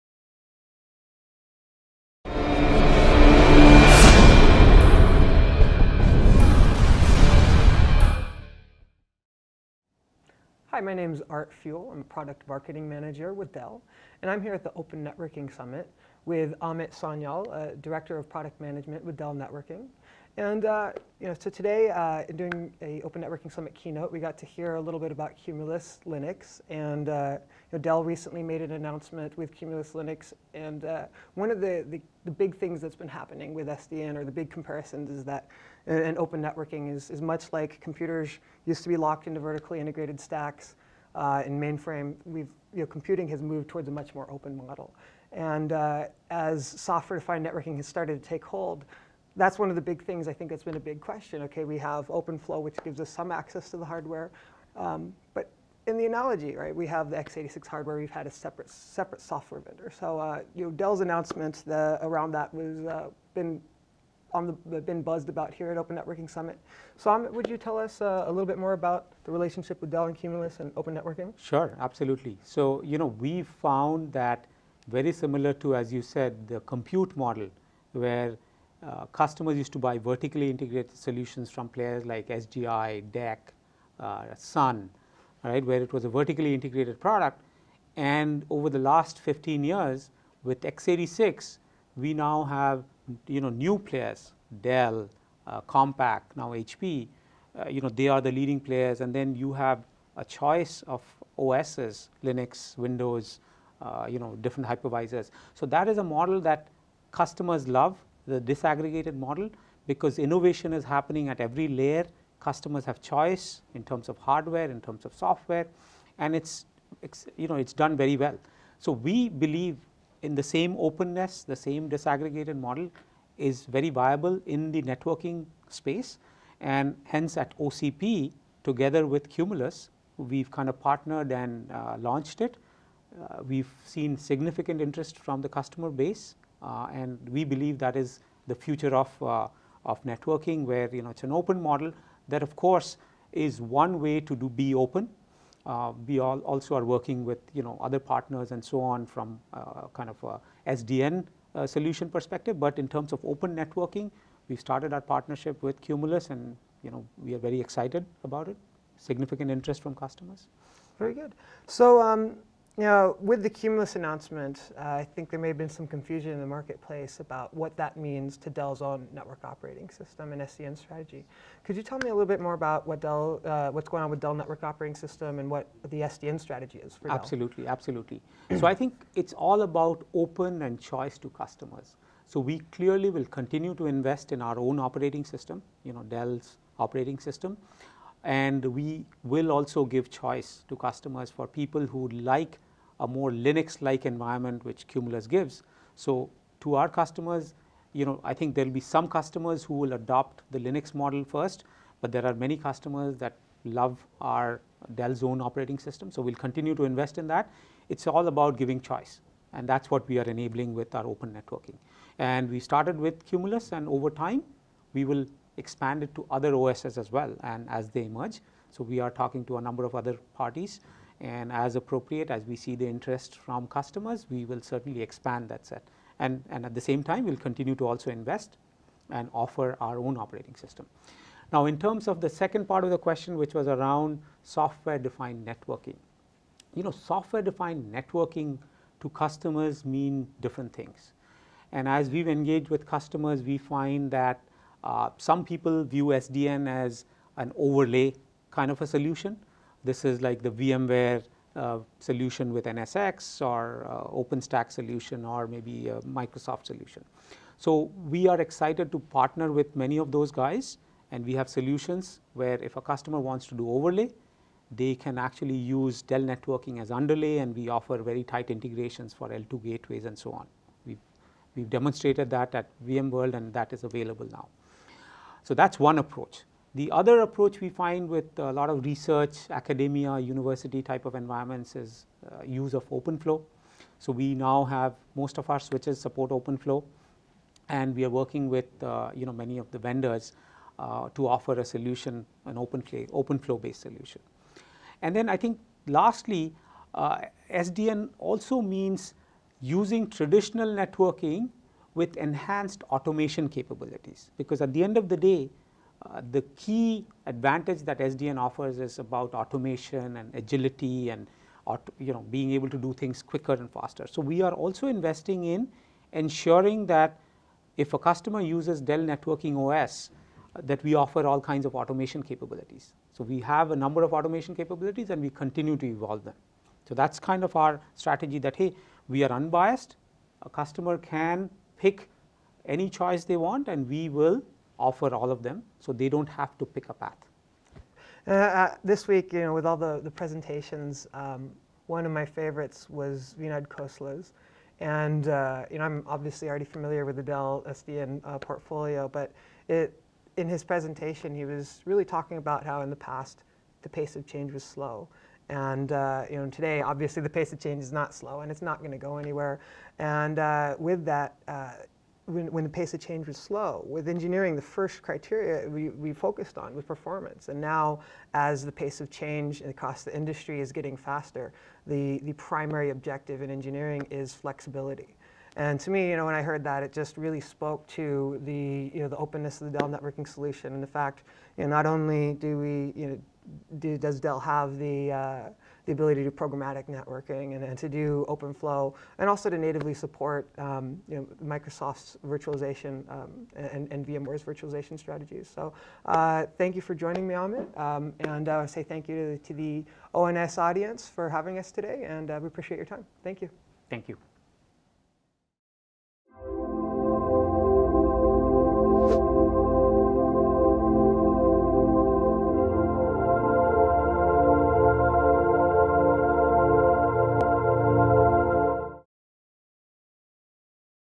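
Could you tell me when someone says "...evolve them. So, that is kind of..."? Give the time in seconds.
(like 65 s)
325 s.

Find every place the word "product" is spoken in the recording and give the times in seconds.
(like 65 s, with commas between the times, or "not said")
12 s, 18 s, 86 s.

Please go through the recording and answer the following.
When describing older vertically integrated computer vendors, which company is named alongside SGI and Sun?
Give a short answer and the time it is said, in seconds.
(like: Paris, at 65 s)
DEC, at 83 s.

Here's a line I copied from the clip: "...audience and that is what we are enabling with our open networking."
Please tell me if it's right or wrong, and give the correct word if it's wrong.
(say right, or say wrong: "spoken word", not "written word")
wrong: "choice", not "audience".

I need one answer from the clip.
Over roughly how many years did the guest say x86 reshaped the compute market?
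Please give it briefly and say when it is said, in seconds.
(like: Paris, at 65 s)
15 years, at 89 s.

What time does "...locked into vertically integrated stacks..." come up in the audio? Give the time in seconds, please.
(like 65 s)
38 s.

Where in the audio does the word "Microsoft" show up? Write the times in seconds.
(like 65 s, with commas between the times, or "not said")
256 s, 391 s.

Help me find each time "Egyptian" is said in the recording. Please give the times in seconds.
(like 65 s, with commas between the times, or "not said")
not said.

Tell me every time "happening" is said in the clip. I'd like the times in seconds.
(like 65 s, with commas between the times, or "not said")
33 s, 110 s.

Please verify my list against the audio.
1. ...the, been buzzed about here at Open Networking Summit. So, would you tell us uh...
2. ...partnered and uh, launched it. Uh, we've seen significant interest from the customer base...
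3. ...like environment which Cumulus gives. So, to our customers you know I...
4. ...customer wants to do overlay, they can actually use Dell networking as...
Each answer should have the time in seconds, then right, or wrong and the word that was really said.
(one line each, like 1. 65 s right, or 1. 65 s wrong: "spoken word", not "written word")
1. 64 s right
2. 130 s right
3. 193 s right
4. 262 s right.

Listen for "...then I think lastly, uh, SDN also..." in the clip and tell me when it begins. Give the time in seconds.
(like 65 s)
295 s.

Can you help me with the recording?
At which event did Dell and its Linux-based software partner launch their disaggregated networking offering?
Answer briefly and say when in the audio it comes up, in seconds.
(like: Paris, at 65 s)
OCP, at 127 s.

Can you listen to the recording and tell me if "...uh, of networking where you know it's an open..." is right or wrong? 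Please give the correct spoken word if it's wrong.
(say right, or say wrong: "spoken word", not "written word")
right.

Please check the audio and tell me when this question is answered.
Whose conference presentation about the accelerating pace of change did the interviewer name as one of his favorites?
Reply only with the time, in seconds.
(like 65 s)
343 s.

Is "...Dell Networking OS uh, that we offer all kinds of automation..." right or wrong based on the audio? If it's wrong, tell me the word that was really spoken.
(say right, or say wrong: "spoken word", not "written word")
right.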